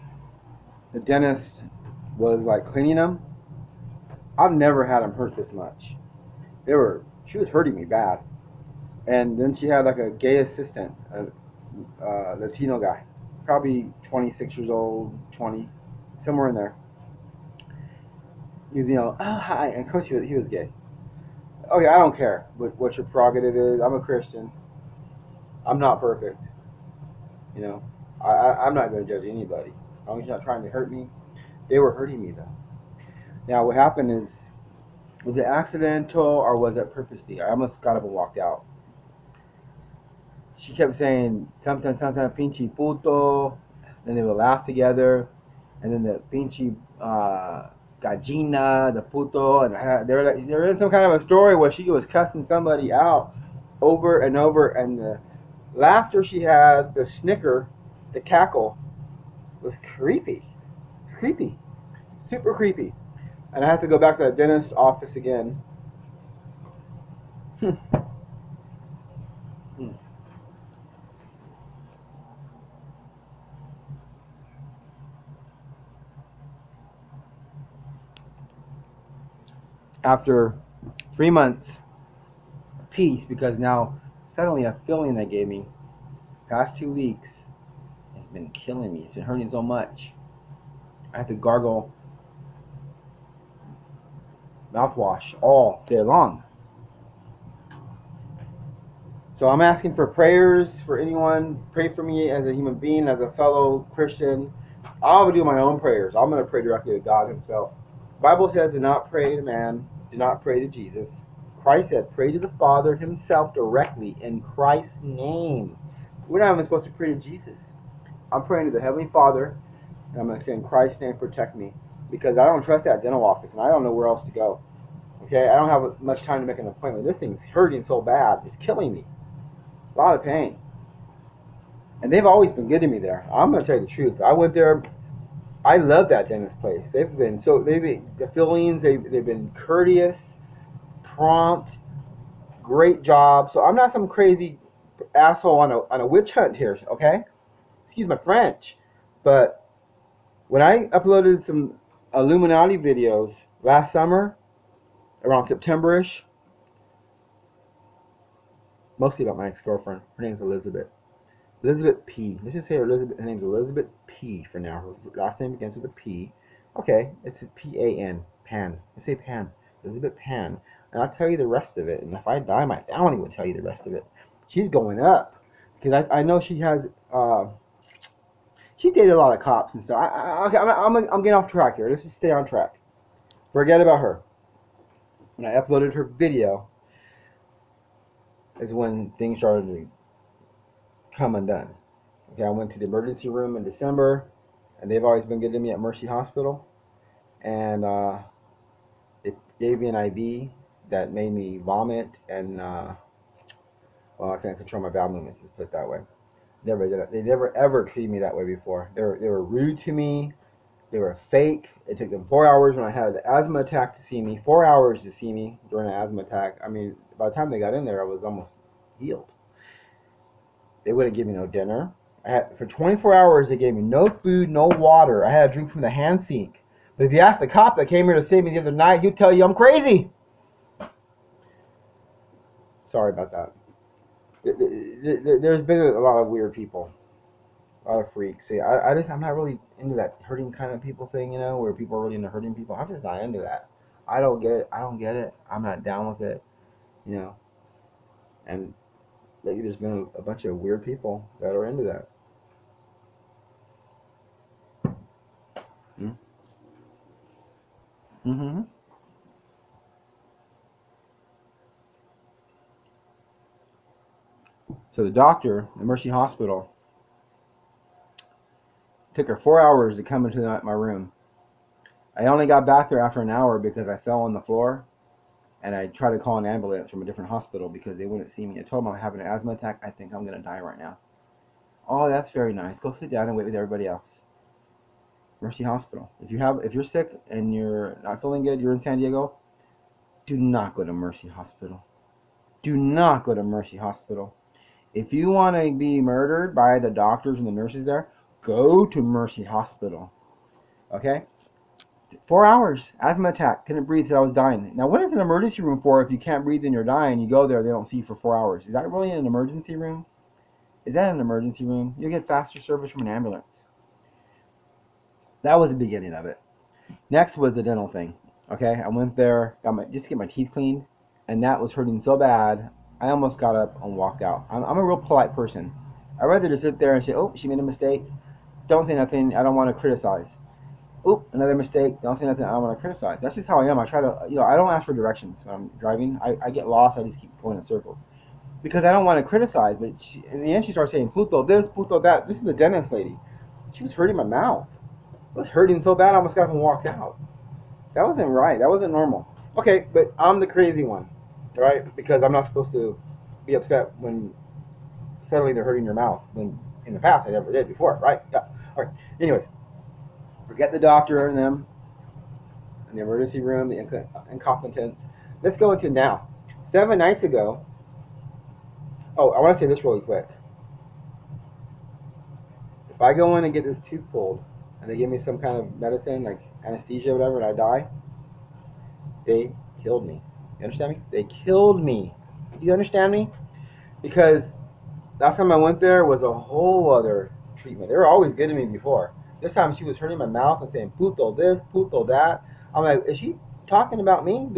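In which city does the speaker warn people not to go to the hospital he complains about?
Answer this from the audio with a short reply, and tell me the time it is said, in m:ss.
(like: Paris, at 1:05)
San Diego, at 4:48.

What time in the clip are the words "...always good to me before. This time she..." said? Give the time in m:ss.
6:28.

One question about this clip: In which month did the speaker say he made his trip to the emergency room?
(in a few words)
December.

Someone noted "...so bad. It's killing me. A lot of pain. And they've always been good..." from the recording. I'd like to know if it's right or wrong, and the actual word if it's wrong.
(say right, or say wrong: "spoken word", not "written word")
right.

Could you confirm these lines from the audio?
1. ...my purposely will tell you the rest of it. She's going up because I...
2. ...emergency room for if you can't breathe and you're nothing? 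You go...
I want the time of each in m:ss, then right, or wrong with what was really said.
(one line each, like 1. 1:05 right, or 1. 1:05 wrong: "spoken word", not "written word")
1. 2:52 wrong: "family", not "purposely"
2. 5:05 wrong: "dying", not "nothing".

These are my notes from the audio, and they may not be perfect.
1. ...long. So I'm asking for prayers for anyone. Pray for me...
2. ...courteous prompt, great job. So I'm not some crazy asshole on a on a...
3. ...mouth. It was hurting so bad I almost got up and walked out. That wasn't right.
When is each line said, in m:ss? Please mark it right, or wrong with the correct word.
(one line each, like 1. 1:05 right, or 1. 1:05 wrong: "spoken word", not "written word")
1. 1:36 right
2. 2:19 right
3. 5:44 right.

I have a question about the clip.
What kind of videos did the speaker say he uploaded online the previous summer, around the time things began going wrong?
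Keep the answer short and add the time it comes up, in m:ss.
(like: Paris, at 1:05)
Illuminati videos, at 2:32.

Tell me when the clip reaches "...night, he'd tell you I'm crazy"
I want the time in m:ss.
3:48.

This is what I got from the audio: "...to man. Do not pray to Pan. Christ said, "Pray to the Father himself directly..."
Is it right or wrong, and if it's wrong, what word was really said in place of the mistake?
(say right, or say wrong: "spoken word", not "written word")
wrong: "Jesus", not "Pan".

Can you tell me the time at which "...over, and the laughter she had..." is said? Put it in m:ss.
0:54.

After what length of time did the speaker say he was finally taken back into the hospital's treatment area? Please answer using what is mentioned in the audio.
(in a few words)
an hour.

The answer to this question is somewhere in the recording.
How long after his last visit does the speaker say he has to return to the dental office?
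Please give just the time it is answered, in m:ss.
1:21.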